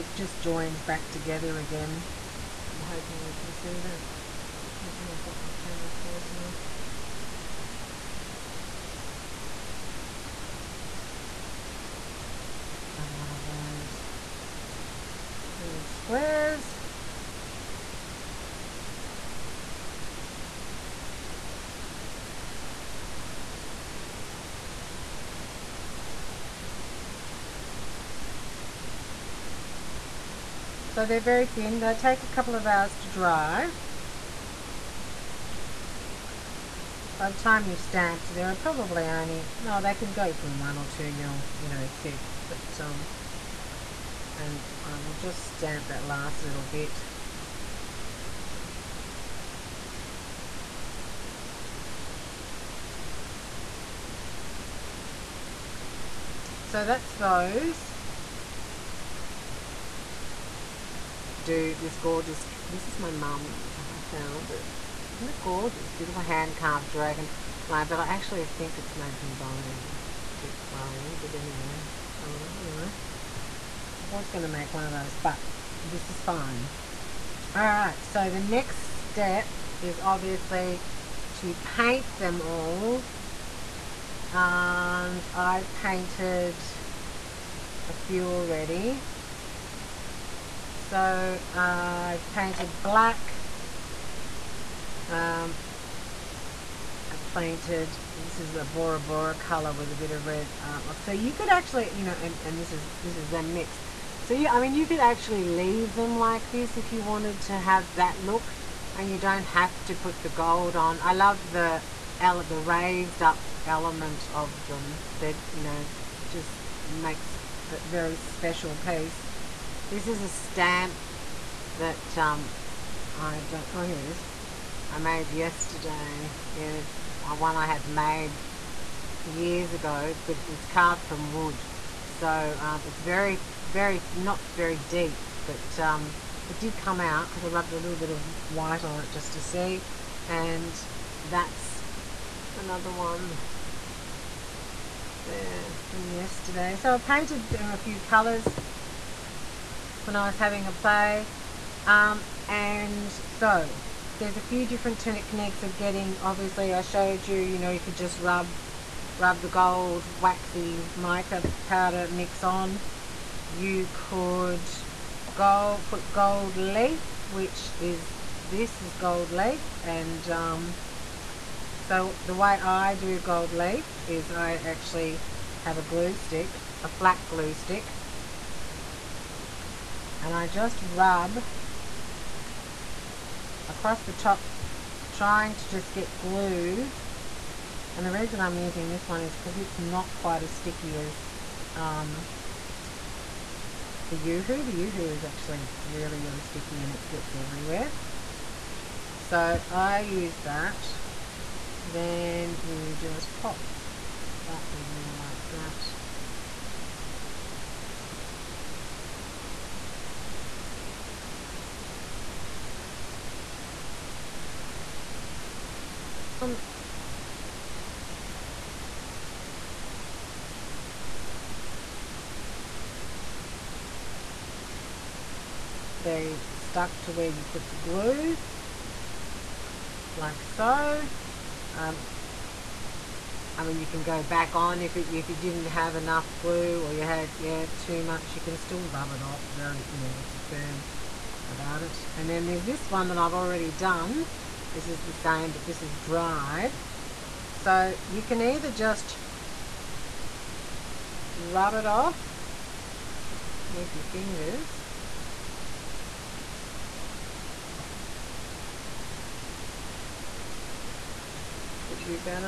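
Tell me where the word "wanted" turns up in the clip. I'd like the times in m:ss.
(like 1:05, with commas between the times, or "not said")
1:47.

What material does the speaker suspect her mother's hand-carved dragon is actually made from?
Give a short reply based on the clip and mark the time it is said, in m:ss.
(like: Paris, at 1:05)
Bone, at 1:09.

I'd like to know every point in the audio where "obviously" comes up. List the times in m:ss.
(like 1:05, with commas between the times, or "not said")
1:19, 2:36.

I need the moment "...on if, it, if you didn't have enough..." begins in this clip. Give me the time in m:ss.
3:54.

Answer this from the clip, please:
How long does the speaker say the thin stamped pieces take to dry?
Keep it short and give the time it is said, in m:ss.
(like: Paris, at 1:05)
A couple of hours, at 0:32.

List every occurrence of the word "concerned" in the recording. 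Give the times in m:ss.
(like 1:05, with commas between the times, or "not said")
not said.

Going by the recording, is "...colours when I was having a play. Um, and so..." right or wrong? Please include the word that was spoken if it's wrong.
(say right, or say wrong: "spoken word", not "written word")
right.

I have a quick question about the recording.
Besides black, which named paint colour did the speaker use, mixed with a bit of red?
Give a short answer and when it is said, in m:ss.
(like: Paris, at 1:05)
Bora Bora, at 1:38.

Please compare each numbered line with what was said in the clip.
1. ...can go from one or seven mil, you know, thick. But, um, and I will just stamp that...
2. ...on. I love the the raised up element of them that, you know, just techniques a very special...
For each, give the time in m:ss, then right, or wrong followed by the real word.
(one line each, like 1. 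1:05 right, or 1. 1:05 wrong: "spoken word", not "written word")
1. 0:39 wrong: "two", not "seven"
2. 1:50 wrong: "makes", not "techniques".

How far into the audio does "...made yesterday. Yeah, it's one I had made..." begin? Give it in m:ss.
2:04.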